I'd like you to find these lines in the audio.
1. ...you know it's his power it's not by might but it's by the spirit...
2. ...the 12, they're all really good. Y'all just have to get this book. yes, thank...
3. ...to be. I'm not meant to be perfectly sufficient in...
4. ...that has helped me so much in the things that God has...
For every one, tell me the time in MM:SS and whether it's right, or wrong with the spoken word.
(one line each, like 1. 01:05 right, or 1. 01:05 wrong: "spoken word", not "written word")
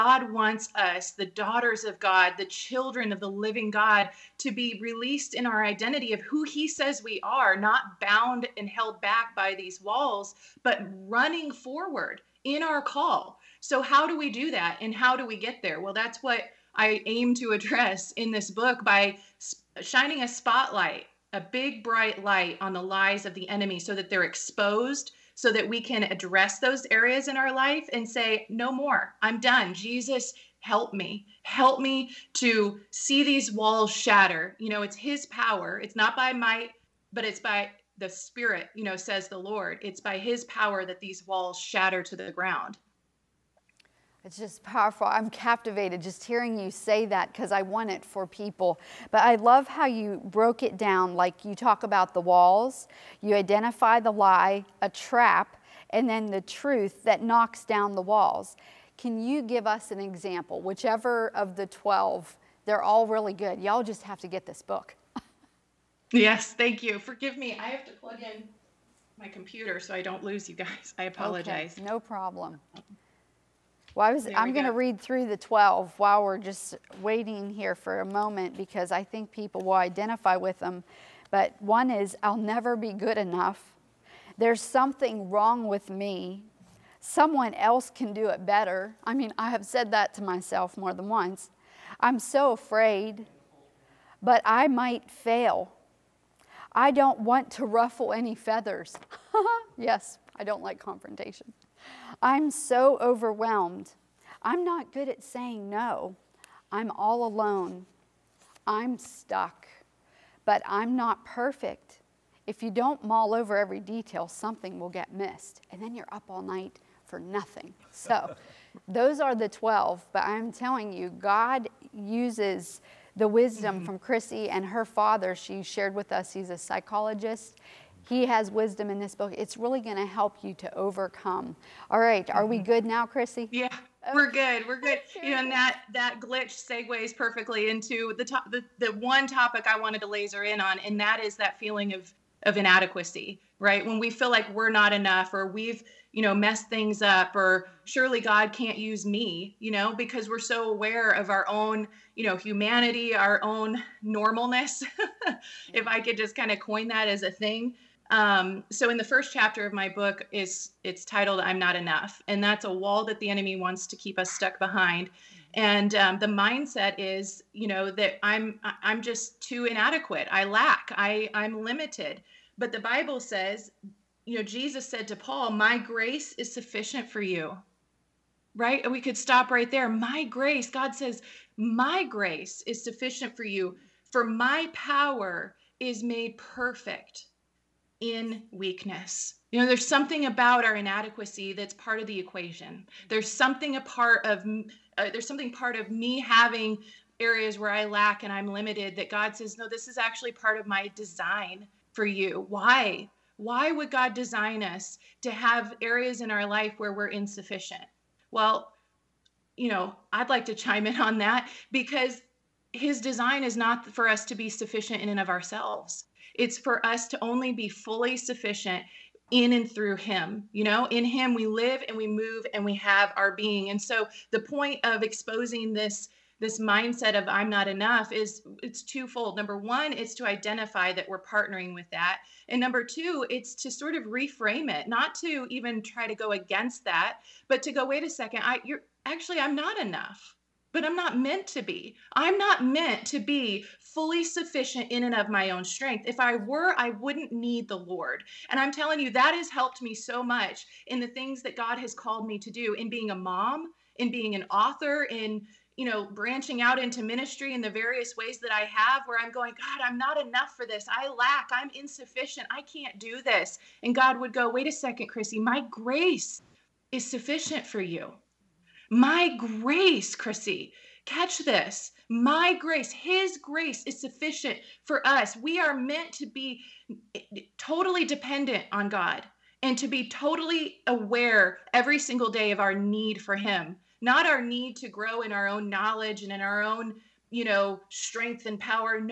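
1. 00:34 right
2. 01:01 right
3. 04:01 wrong: "fully", not "perfectly"
4. 04:09 right.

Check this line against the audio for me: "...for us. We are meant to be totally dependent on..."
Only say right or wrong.
right.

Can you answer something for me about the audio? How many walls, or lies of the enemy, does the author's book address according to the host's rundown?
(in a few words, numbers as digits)
12.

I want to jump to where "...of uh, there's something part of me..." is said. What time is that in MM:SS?
03:14.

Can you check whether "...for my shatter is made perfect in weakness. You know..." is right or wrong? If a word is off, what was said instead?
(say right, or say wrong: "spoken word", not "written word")
wrong: "power", not "shatter".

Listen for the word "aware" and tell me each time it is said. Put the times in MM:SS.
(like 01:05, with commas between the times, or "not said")
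02:30, 04:40.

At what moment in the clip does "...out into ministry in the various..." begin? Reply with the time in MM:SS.
04:16.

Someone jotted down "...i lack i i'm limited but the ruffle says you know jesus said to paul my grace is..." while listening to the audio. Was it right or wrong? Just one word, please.
wrong.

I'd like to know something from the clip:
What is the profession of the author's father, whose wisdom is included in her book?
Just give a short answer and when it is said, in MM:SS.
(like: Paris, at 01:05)
psychologist, at 02:06.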